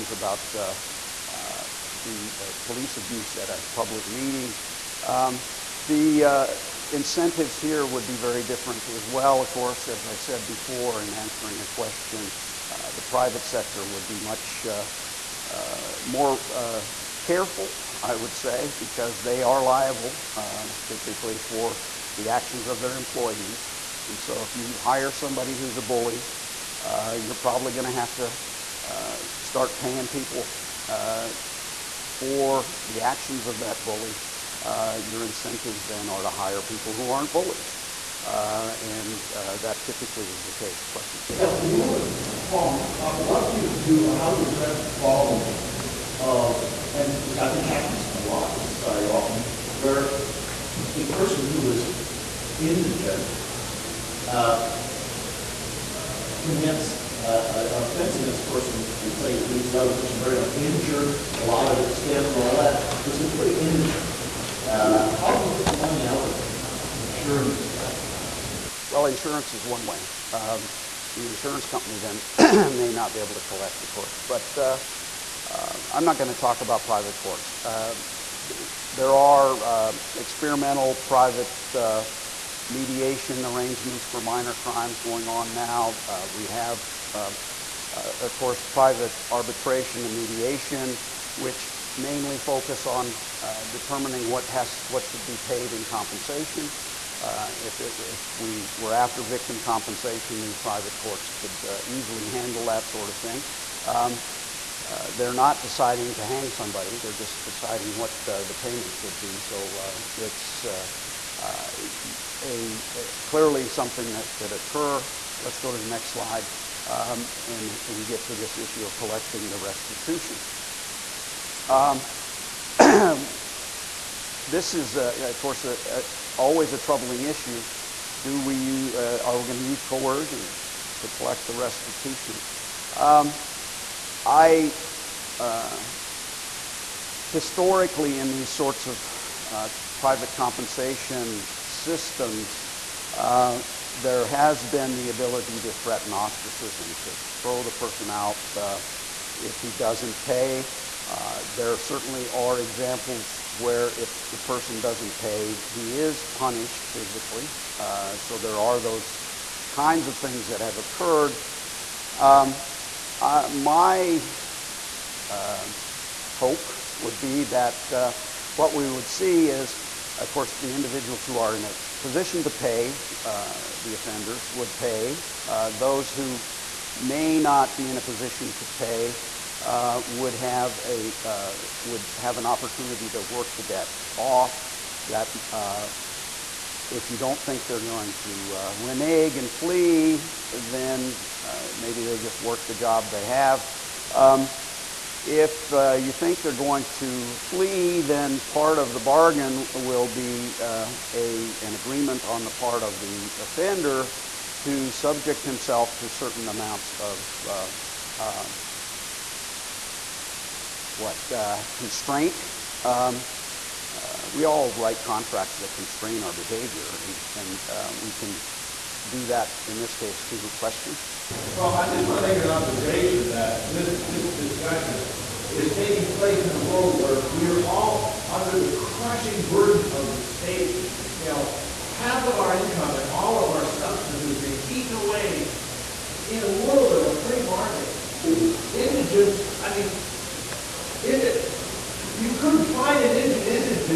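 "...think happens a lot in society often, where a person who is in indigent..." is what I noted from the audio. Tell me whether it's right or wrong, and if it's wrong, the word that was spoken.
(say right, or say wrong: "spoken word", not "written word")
right.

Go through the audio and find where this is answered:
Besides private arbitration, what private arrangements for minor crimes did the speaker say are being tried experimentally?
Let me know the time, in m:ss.
1:22.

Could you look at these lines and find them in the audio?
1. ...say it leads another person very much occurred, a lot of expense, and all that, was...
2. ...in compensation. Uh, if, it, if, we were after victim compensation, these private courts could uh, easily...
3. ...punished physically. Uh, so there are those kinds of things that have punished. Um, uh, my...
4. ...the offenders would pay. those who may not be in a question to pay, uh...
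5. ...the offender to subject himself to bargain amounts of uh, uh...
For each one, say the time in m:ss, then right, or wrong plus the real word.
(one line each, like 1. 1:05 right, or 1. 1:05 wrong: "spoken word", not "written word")
1. 0:59 wrong: "injured", not "occurred"
2. 1:35 right
3. 2:36 wrong: "occurred", not "punished"
4. 2:53 wrong: "position", not "question"
5. 3:22 wrong: "certain", not "bargain".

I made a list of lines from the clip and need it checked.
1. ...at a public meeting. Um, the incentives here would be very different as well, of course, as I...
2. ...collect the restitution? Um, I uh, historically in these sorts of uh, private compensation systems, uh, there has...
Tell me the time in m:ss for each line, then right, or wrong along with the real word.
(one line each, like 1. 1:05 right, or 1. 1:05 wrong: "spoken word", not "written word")
1. 0:03 right
2. 2:11 right.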